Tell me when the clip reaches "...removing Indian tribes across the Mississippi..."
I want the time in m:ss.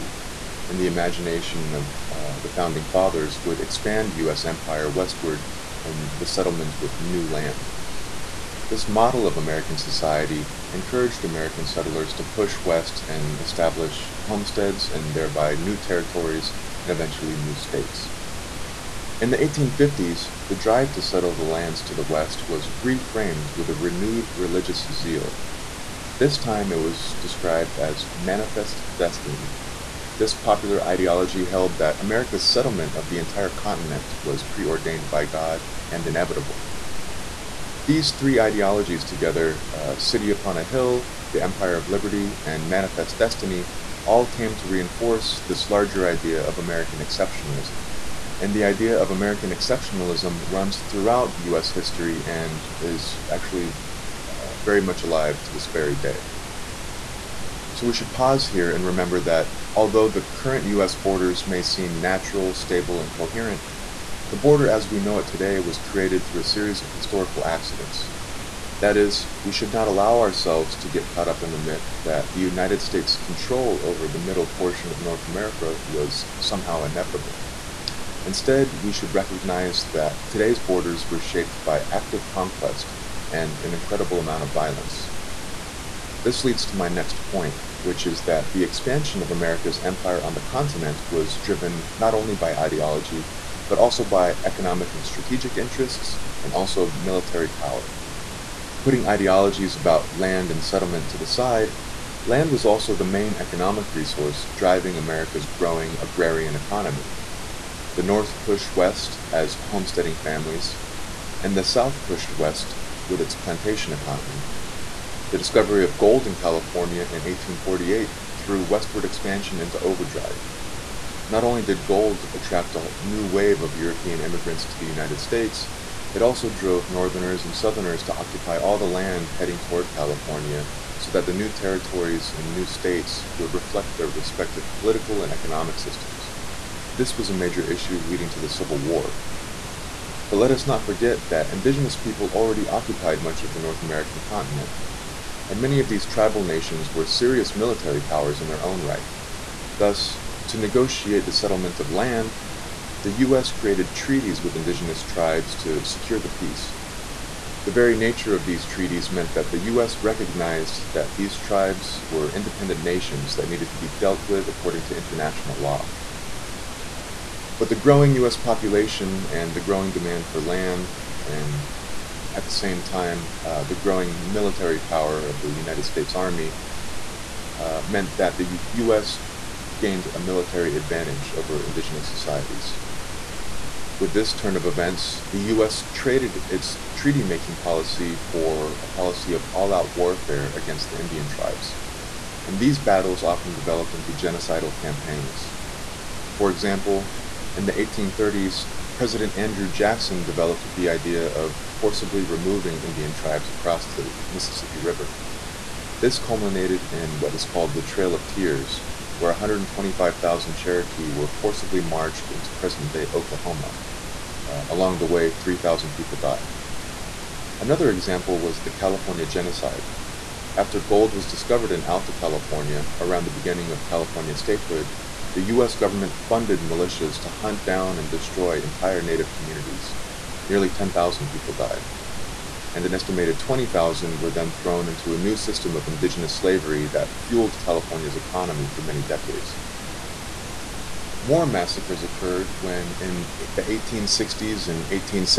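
3:22.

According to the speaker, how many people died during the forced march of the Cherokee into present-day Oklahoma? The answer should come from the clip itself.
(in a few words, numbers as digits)
3,000.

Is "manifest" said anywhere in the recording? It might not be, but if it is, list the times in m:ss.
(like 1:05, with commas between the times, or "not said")
0:28, 0:42.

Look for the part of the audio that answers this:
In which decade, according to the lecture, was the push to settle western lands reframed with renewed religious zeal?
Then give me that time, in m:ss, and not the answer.
0:19.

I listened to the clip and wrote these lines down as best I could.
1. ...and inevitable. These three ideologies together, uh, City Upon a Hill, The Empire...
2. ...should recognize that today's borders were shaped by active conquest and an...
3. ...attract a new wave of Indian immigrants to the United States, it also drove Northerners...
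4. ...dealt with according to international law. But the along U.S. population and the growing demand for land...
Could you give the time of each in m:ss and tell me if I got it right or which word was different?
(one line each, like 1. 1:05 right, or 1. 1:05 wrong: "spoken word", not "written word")
1. 0:35 right
2. 1:18 right
3. 2:02 wrong: "European", not "Indian"
4. 2:43 wrong: "growing", not "along".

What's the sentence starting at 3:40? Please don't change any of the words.
After gold was discovered in Alta California around the beginning of California statehood, the U.S.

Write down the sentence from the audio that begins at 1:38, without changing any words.
Putting ideologies about land and settlement to the side, land was also the main economic resource driving America's growing agrarian economy.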